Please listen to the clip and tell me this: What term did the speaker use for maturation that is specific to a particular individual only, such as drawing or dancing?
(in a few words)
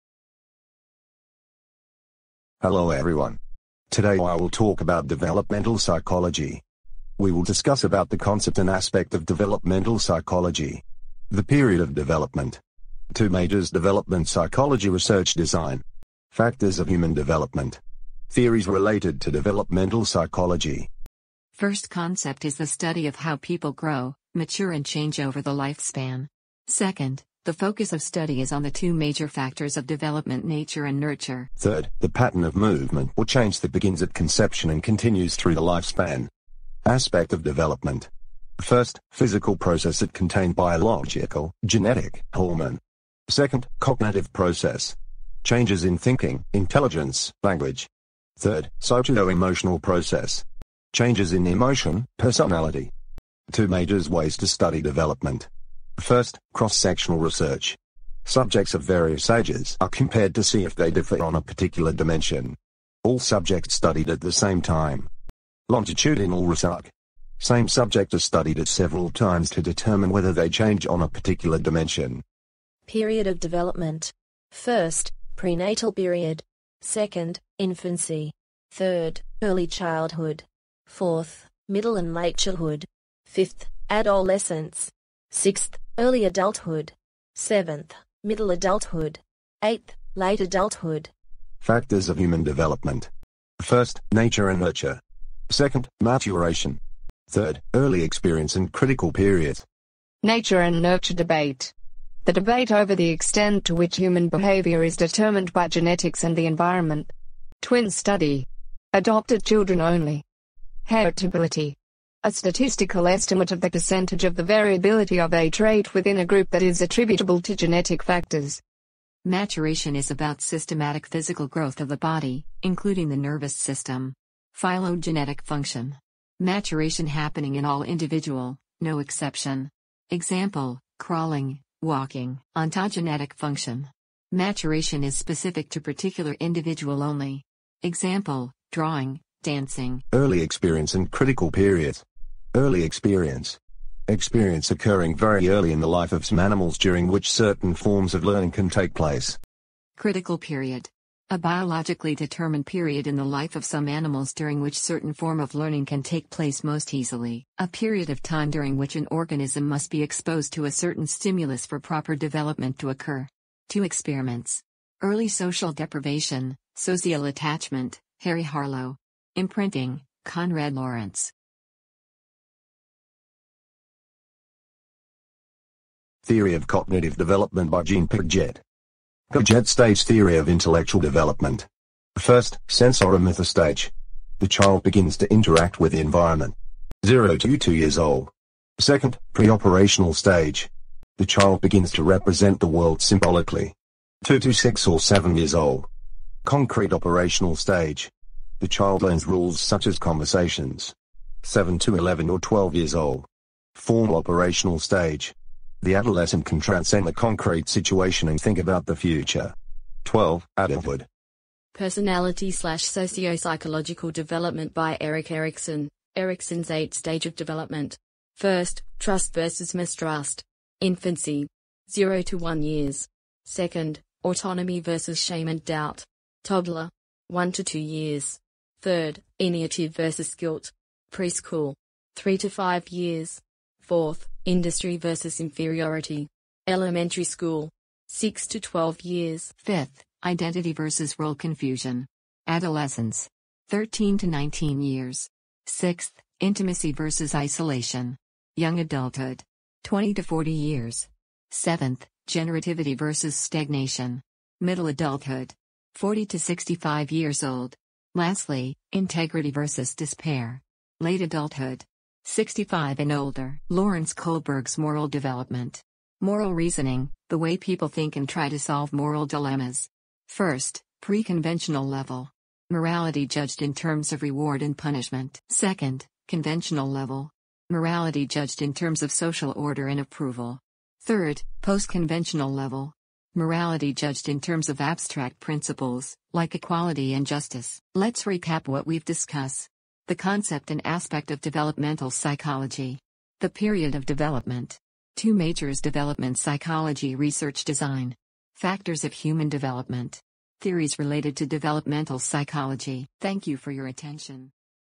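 Ontogenetic function.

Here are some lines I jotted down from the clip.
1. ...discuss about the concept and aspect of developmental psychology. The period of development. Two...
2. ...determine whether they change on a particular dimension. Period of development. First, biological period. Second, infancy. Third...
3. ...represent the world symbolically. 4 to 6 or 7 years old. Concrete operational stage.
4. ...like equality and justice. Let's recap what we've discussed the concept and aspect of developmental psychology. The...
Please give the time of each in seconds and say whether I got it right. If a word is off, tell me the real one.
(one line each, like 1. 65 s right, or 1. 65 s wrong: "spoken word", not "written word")
1. 7 s right
2. 69 s wrong: "prenatal", not "biological"
3. 192 s wrong: "2", not "4"
4. 286 s right.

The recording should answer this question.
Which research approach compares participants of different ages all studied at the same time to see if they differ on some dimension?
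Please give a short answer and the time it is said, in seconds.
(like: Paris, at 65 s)
Cross-sectional research, at 56 s.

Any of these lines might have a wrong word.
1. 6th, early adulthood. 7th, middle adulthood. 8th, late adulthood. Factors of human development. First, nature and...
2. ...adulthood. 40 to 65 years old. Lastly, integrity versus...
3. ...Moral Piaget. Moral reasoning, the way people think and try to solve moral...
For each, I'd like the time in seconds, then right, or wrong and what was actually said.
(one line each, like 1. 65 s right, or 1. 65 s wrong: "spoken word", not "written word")
1. 85 s right
2. 254 s right
3. 264 s wrong: "Development", not "Piaget".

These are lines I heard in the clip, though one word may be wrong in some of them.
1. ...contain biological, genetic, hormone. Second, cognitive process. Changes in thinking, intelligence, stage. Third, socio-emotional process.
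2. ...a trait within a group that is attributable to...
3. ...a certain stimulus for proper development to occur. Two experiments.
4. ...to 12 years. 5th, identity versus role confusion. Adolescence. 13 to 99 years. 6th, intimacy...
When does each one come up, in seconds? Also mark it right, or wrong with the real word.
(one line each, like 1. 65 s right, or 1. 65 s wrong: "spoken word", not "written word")
1. 40 s wrong: "language", not "stage"
2. 115 s right
3. 160 s right
4. 238 s wrong: "19", not "99".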